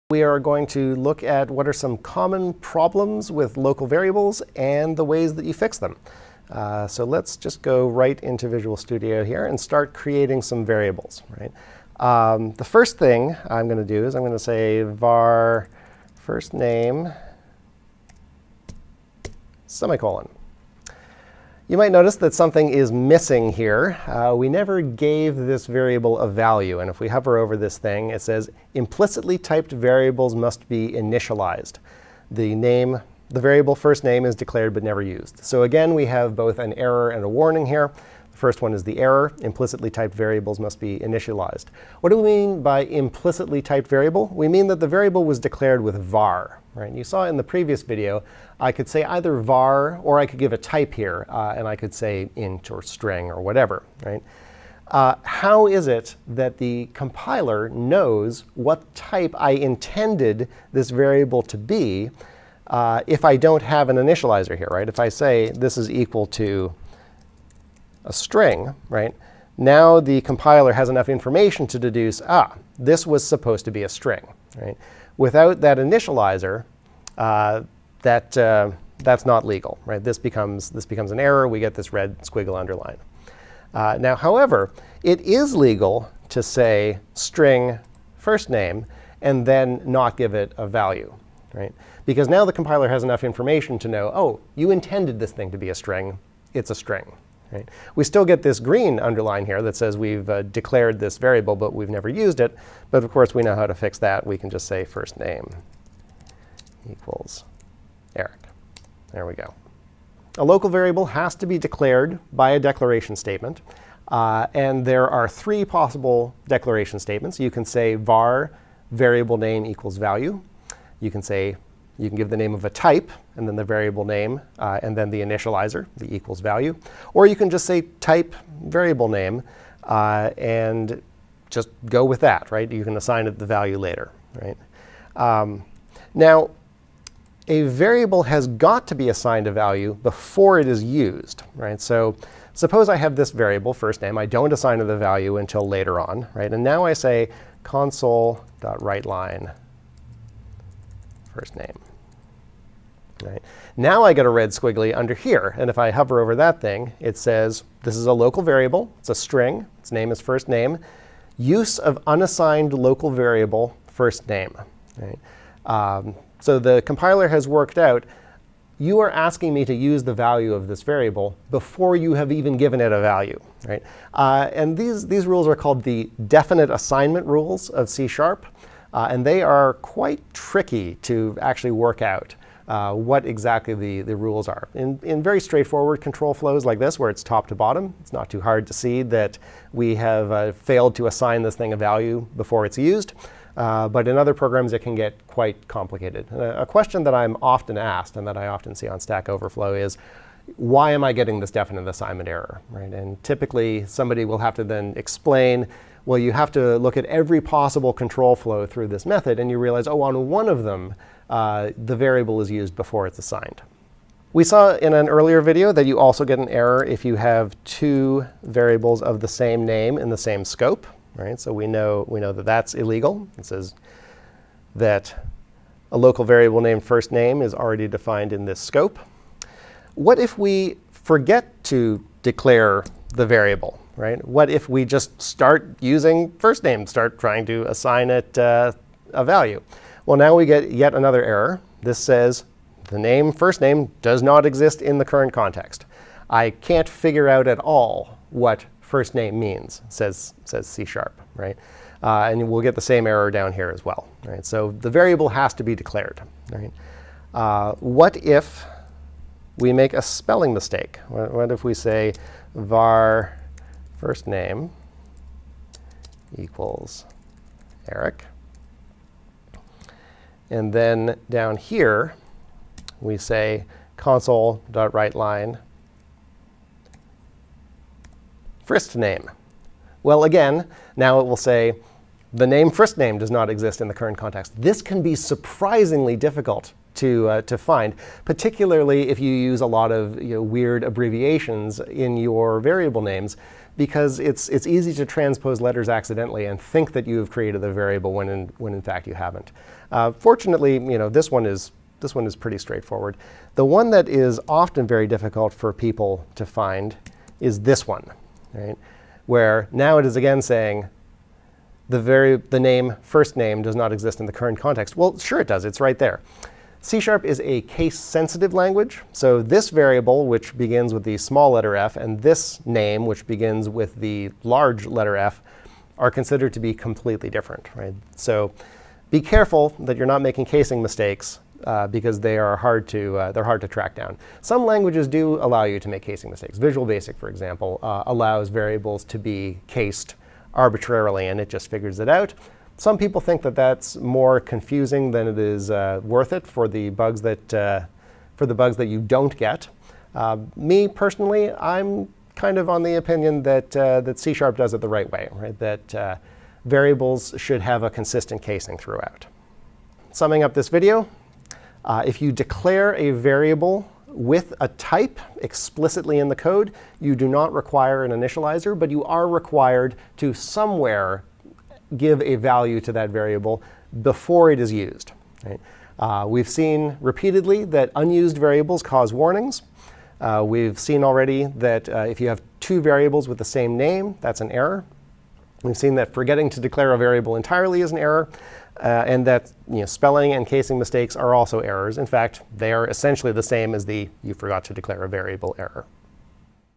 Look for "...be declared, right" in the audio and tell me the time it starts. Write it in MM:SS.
04:15.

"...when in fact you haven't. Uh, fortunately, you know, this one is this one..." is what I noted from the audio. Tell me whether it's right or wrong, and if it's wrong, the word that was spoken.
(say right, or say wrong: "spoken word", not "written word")
right.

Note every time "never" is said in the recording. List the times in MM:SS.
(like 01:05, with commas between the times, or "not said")
00:24, 00:34, 01:41.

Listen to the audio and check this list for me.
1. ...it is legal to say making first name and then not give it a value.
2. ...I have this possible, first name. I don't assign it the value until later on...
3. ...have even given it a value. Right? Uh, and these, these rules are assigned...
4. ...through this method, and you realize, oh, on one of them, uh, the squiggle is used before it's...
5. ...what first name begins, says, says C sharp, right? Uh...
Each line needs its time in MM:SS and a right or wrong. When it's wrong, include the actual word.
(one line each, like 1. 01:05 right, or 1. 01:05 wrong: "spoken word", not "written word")
1. 01:25 wrong: "string", not "making"
2. 02:22 wrong: "variable", not "possible"
3. 02:52 wrong: "called", not "assigned"
4. 03:28 wrong: "variable", not "squiggle"
5. 04:08 wrong: "means", not "begins".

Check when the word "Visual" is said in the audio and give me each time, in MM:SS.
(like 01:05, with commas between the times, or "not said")
00:08, 05:36.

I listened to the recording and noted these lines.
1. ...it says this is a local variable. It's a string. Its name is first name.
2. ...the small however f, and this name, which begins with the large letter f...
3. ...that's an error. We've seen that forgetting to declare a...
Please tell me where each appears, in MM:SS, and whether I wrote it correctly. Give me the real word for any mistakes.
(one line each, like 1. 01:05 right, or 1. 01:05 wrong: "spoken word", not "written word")
1. 02:36 right
2. 05:21 wrong: "letter", not "however"
3. 06:24 right.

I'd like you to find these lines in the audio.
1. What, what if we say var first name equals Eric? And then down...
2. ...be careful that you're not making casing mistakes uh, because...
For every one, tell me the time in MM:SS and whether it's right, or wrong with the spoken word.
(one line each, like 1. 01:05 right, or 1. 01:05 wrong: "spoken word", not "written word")
1. 04:21 right
2. 05:29 right.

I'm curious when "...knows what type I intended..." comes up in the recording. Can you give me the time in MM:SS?
00:57.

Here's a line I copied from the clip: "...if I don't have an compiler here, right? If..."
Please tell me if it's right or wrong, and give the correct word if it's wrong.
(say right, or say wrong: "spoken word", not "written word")
wrong: "initializer", not "compiler".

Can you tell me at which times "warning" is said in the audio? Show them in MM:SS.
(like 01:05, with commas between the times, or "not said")
00:37, 06:19.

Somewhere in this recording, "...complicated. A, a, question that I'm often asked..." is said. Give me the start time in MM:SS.
03:15.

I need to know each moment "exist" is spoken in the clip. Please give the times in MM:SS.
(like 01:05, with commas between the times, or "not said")
04:04, 04:43, 05:13.